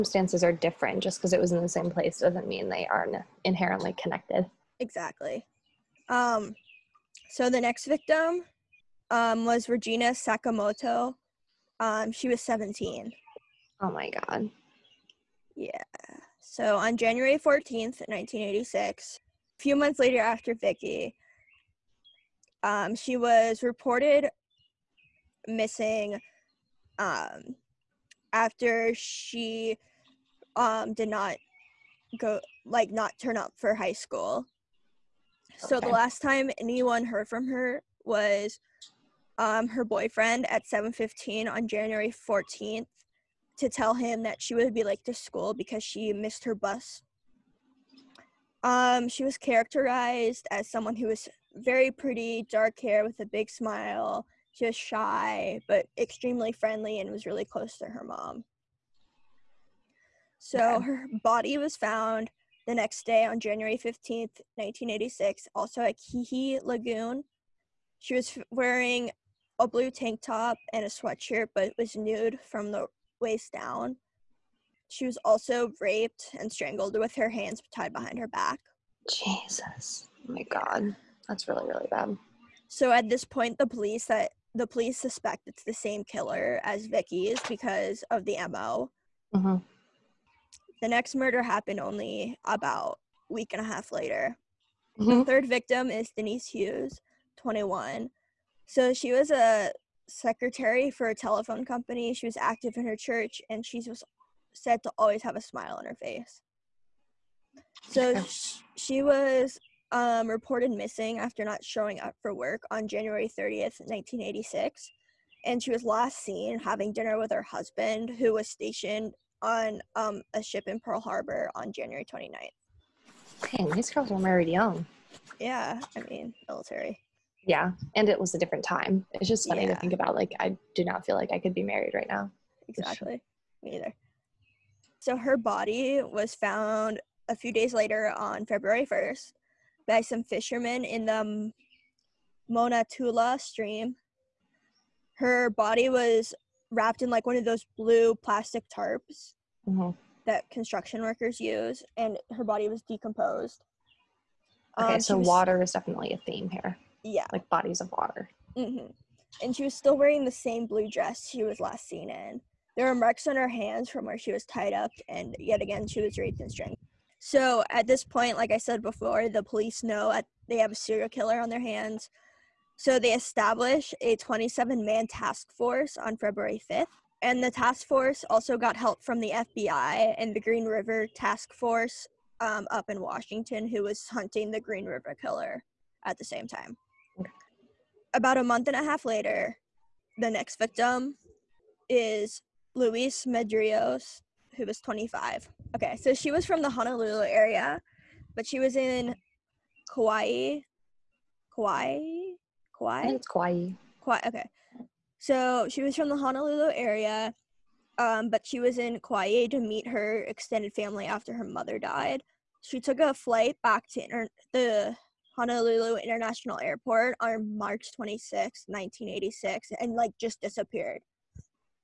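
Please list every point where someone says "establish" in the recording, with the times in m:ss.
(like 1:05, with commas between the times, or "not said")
2:53.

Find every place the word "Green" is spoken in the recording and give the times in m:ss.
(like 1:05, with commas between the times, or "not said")
3:00, 3:04.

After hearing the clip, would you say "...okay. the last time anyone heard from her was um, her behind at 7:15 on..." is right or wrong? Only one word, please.
wrong.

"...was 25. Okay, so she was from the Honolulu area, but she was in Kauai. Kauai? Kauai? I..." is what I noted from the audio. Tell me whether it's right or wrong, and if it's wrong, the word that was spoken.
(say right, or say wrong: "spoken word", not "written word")
right.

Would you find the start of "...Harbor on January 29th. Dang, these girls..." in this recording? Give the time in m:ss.
2:00.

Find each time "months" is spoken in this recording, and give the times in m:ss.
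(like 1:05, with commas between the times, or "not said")
0:19, 3:08.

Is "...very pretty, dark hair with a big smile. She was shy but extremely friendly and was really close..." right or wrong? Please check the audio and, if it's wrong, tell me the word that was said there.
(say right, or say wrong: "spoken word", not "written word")
right.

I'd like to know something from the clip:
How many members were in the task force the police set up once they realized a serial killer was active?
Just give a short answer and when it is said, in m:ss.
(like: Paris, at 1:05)
27, at 2:54.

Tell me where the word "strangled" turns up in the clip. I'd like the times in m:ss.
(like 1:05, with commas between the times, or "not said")
1:16, 2:46.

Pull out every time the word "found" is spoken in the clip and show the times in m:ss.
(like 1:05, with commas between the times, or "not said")
1:01, 2:16.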